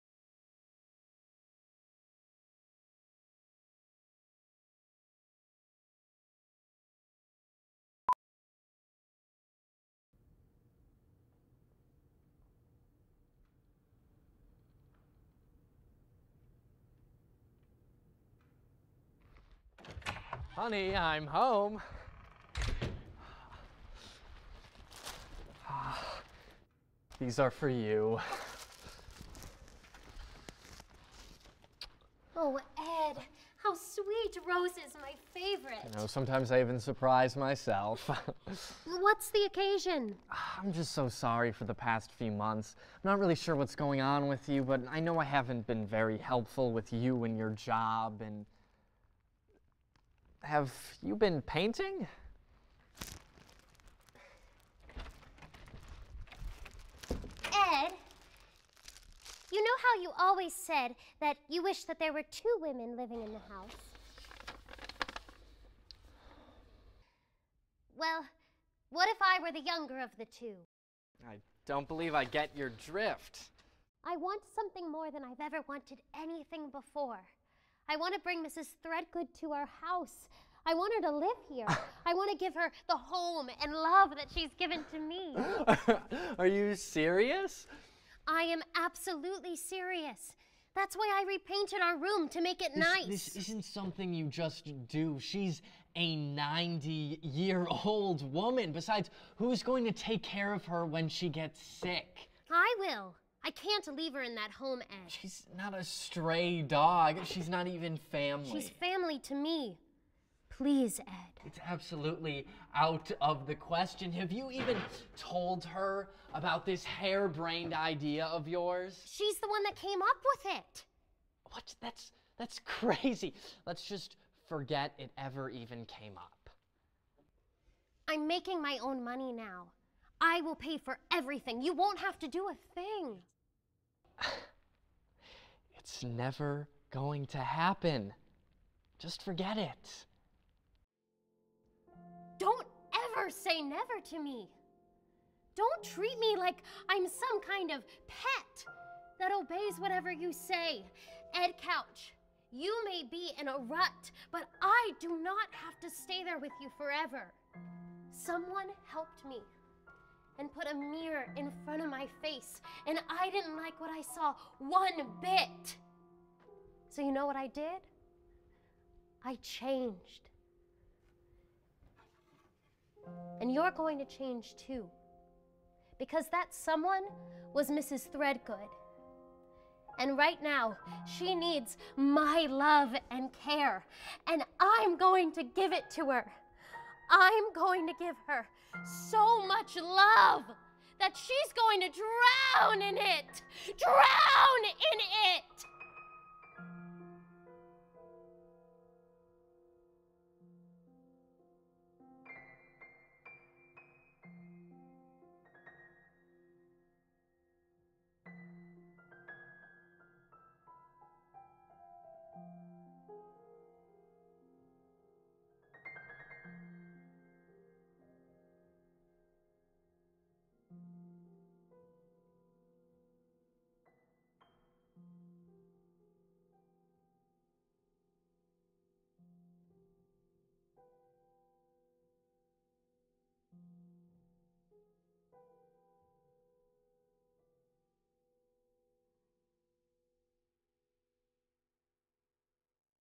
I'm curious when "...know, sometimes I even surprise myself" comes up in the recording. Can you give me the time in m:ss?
0:36.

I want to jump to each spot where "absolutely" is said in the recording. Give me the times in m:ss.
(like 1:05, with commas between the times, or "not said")
1:28, 1:51.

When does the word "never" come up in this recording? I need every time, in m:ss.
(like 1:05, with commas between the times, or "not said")
2:16, 2:23.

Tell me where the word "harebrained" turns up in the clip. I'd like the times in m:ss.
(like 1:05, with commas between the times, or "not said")
1:56.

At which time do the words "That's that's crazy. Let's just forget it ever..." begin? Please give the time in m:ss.
2:01.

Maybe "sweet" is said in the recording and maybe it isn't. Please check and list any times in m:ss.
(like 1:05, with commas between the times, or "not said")
0:33.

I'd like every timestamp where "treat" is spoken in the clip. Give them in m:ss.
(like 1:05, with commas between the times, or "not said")
2:25.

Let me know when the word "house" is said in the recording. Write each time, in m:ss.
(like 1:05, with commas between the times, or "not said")
1:03, 1:19.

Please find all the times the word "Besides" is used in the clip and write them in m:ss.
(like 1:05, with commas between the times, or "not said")
1:38.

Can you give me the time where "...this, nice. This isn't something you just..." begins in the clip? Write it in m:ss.
1:32.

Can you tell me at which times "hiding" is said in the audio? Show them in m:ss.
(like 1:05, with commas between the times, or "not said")
not said.